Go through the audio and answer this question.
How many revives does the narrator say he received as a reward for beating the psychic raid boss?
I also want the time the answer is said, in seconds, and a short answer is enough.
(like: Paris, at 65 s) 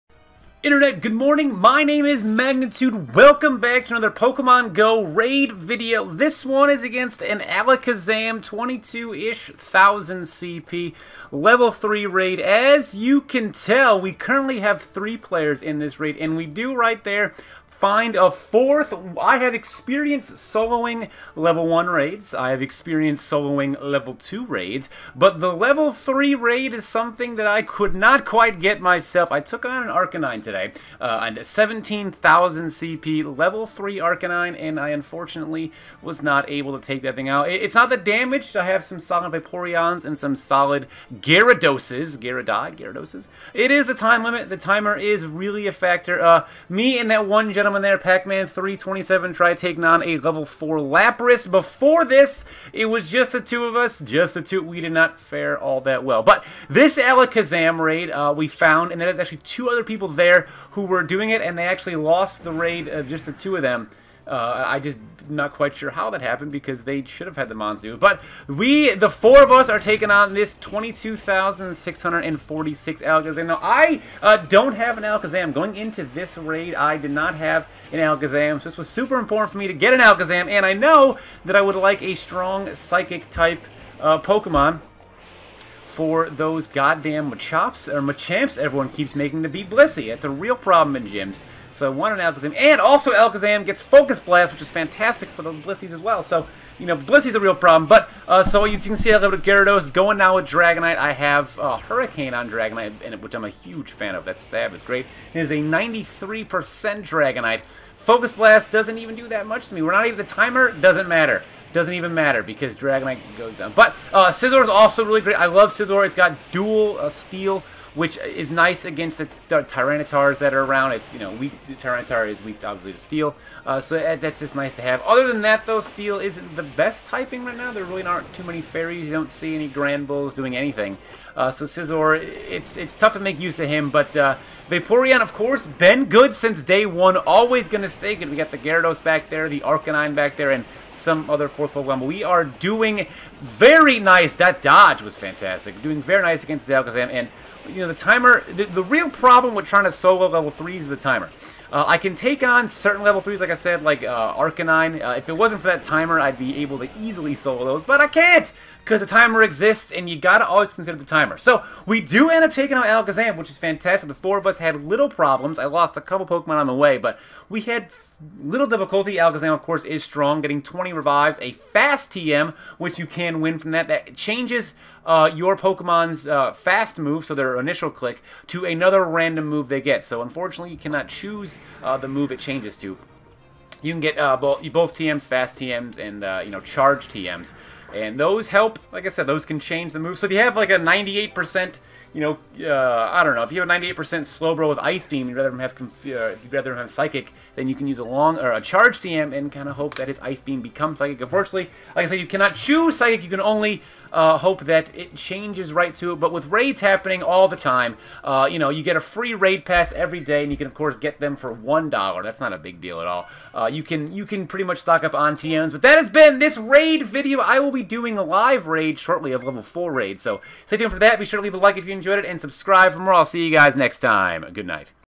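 20, at 170 s.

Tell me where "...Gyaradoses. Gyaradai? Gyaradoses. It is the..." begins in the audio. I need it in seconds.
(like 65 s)
41 s.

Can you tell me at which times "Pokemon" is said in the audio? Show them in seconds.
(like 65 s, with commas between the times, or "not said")
4 s, 84 s, 141 s, 166 s, 175 s.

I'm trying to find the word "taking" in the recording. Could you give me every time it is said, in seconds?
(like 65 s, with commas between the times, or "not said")
49 s, 69 s, 162 s.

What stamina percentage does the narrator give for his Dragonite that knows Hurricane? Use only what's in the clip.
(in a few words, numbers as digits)
93%.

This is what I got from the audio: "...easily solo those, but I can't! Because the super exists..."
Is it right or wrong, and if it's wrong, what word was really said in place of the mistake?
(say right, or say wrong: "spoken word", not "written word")
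wrong: "timer", not "super".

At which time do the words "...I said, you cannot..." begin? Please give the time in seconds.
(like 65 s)
202 s.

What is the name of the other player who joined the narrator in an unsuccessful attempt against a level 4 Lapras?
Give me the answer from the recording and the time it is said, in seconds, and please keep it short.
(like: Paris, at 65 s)
Pac-Man 327, at 47 s.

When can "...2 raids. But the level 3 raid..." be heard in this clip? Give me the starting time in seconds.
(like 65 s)
24 s.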